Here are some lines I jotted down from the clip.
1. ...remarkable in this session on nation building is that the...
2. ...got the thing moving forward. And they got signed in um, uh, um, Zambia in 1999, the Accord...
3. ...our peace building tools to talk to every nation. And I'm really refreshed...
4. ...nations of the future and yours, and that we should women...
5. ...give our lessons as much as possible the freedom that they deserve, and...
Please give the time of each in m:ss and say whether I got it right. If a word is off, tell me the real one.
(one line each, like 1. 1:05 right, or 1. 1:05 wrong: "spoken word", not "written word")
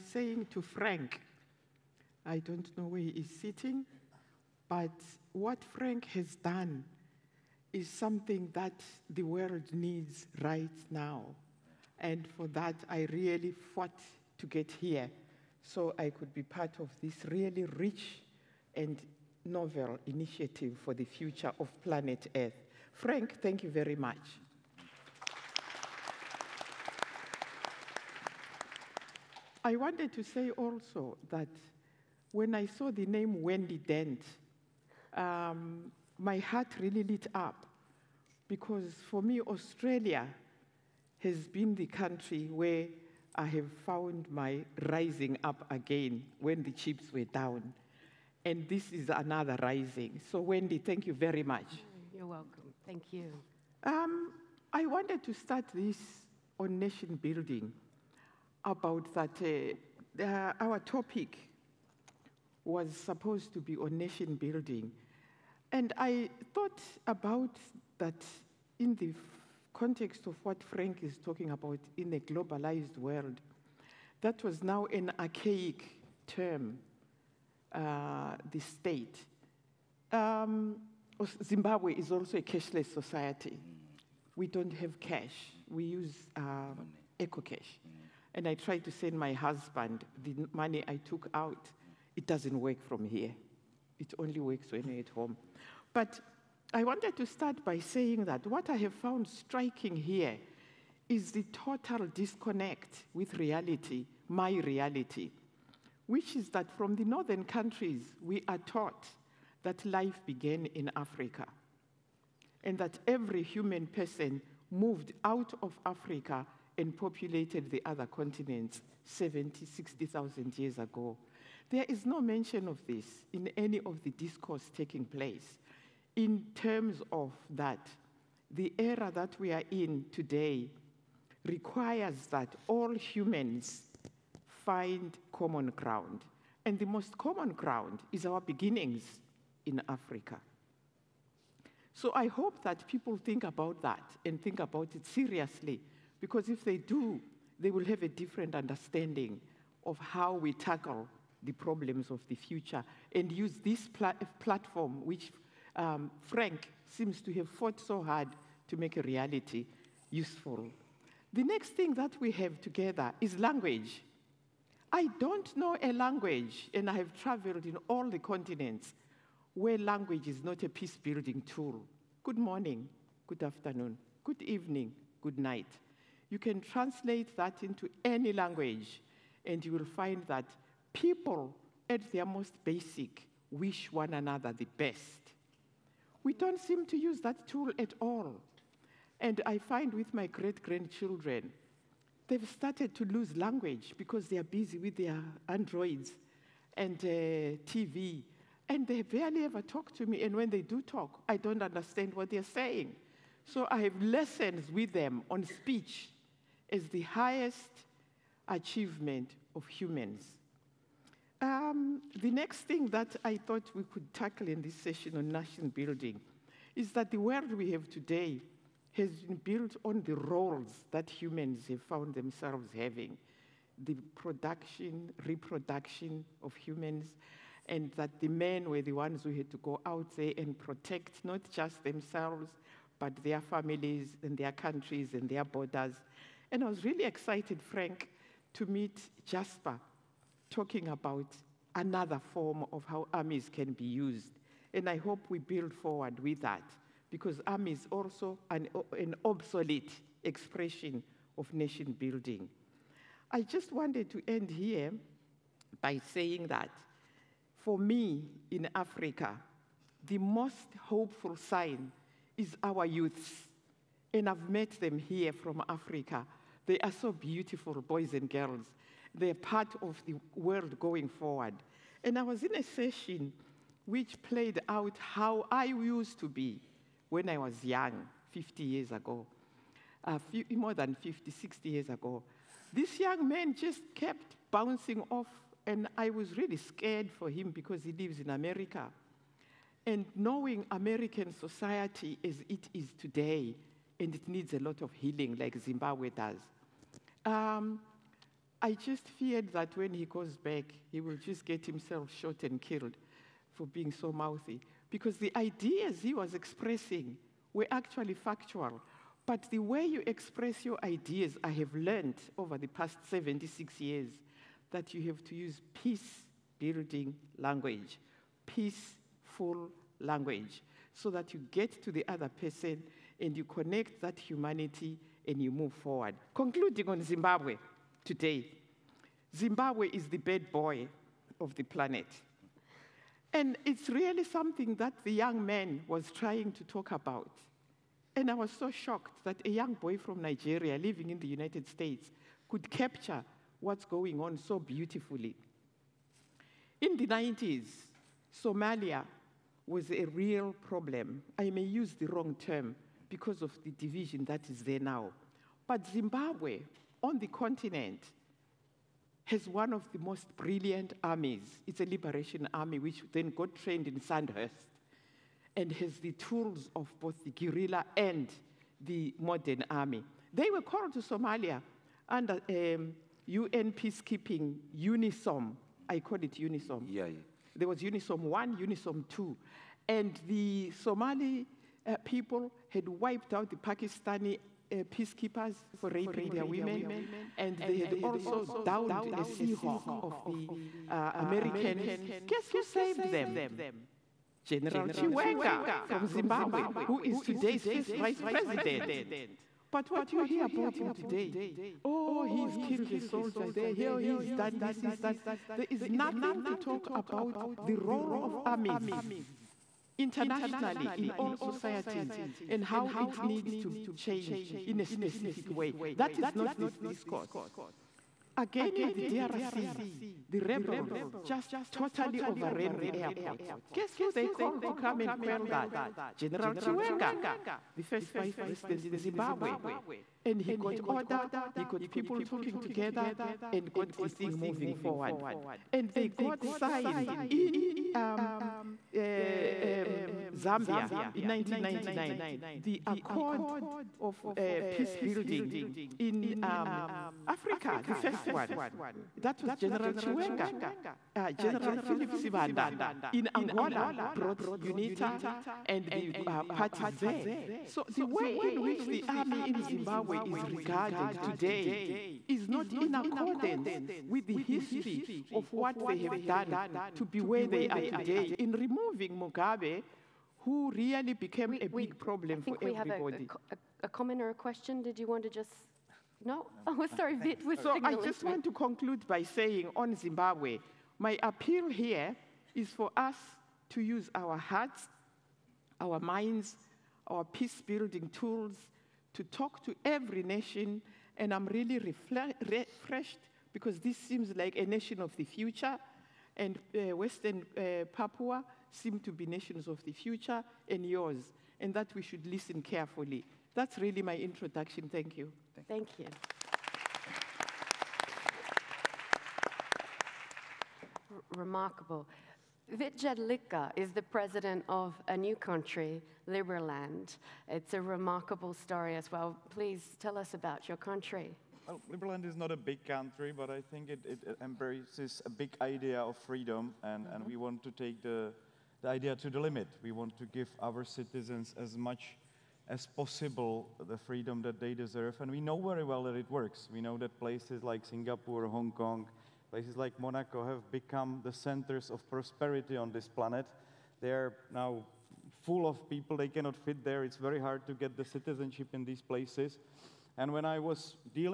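1. 3:34 wrong: "tackle", not "remarkable"
2. 7:13 right
3. 8:07 right
4. 8:19 wrong: "listen", not "women"
5. 8:50 wrong: "citizens", not "lessons".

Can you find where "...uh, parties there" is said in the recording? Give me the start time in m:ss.
7:36.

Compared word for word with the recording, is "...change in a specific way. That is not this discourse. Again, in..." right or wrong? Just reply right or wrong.
right.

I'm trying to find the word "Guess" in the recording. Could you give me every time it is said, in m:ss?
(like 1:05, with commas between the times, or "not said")
6:32, 7:03.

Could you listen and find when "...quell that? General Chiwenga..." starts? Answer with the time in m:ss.
7:05.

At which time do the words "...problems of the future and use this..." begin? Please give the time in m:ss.
2:31.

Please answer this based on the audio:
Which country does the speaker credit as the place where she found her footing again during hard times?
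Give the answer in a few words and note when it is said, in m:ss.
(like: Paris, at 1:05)
Australia, at 0:39.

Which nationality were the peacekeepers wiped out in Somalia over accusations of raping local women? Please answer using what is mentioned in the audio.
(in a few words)
Pakistani.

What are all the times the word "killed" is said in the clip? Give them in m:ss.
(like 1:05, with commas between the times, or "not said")
5:02, 6:42.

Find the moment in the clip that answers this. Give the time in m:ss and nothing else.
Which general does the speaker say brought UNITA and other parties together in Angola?
7:31.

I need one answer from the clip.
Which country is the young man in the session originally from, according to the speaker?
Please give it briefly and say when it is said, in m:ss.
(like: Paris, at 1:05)
Nigeria, at 5:40.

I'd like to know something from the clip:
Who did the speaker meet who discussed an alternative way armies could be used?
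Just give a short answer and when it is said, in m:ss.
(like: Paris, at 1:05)
Jasper, at 3:59.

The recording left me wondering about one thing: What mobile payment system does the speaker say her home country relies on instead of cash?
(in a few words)
EcoCash.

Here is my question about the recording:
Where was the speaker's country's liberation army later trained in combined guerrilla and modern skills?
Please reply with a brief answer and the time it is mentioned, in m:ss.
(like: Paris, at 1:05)
Sandhurst, at 6:04.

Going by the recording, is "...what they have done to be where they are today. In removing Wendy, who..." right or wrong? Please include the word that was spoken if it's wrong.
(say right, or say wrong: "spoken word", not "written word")
wrong: "Mugabe", not "Wendy".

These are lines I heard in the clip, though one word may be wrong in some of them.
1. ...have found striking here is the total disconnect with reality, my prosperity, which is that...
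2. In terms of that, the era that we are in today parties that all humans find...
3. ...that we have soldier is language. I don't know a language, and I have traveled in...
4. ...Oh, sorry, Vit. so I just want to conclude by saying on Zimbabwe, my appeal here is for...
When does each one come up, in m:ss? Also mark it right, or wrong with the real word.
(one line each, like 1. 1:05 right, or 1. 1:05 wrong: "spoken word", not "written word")
1. 1:38 wrong: "reality", not "prosperity"
2. 2:06 wrong: "requires", not "parties"
3. 2:41 wrong: "together", not "soldier"
4. 7:56 right.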